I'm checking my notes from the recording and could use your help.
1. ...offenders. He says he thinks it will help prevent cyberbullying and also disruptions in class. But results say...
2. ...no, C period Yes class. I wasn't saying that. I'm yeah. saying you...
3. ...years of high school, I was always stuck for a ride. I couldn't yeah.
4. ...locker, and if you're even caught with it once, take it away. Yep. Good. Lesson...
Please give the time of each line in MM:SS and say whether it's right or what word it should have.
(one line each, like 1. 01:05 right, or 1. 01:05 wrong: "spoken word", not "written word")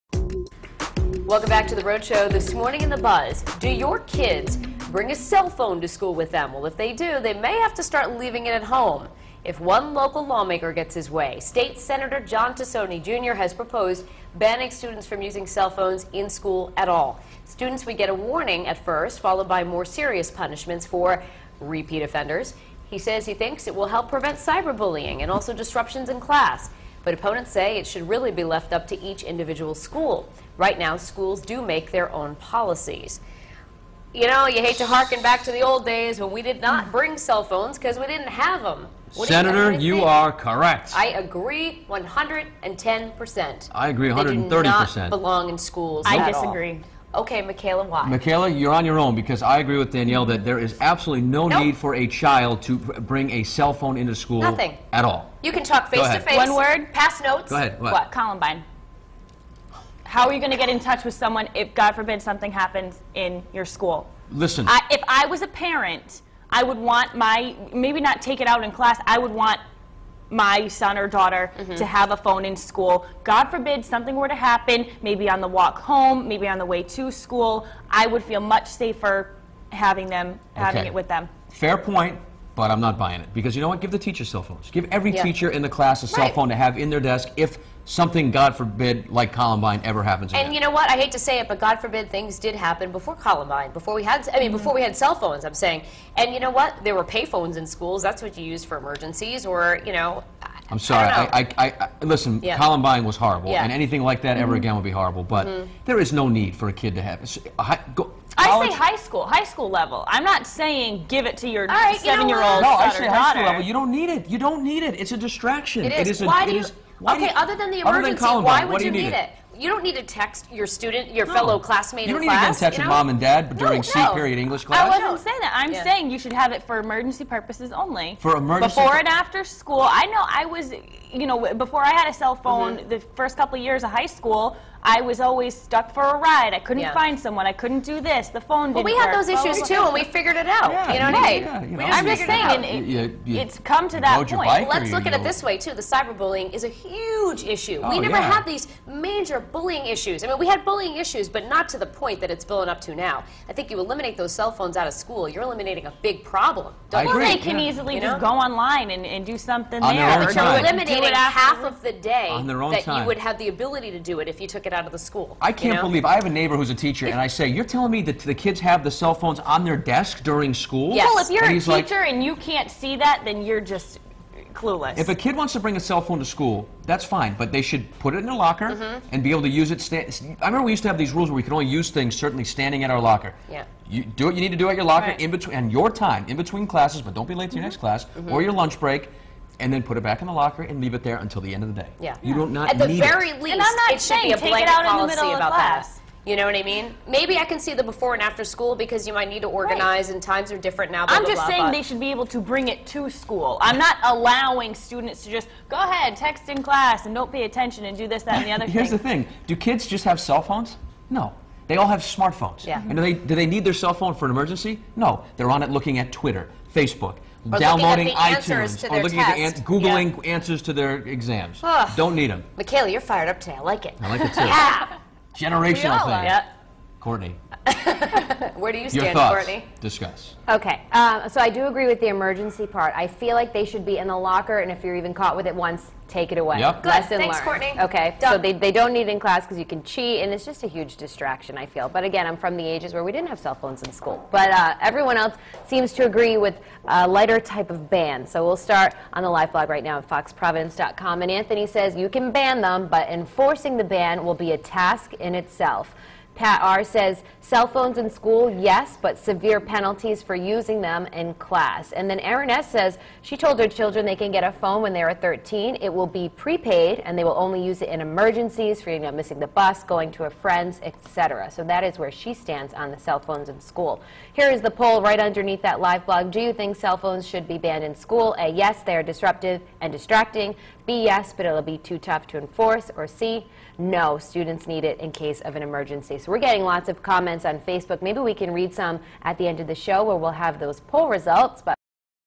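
1. 00:22 wrong: "opponents", not "results"
2. 02:03 wrong: "English", not "Yes"
3. 02:13 right
4. 03:54 right.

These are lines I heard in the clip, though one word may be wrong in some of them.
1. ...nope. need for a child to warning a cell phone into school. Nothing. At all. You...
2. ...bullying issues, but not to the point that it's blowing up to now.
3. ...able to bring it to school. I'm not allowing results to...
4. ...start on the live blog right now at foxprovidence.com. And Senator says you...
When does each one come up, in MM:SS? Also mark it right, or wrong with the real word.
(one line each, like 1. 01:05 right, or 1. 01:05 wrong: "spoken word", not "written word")
1. 00:51 wrong: "bring", not "warning"
2. 02:30 right
3. 03:22 wrong: "students", not "results"
4. 04:08 wrong: "Anthony", not "Senator".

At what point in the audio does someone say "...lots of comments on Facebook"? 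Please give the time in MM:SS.
04:46.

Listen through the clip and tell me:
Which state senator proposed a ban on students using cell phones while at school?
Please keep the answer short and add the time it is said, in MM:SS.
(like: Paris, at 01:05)
John Tassoni Jr., at 00:12.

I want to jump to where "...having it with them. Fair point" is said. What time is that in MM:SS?
01:20.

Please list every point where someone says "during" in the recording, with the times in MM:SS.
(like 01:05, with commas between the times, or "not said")
02:03, 02:50.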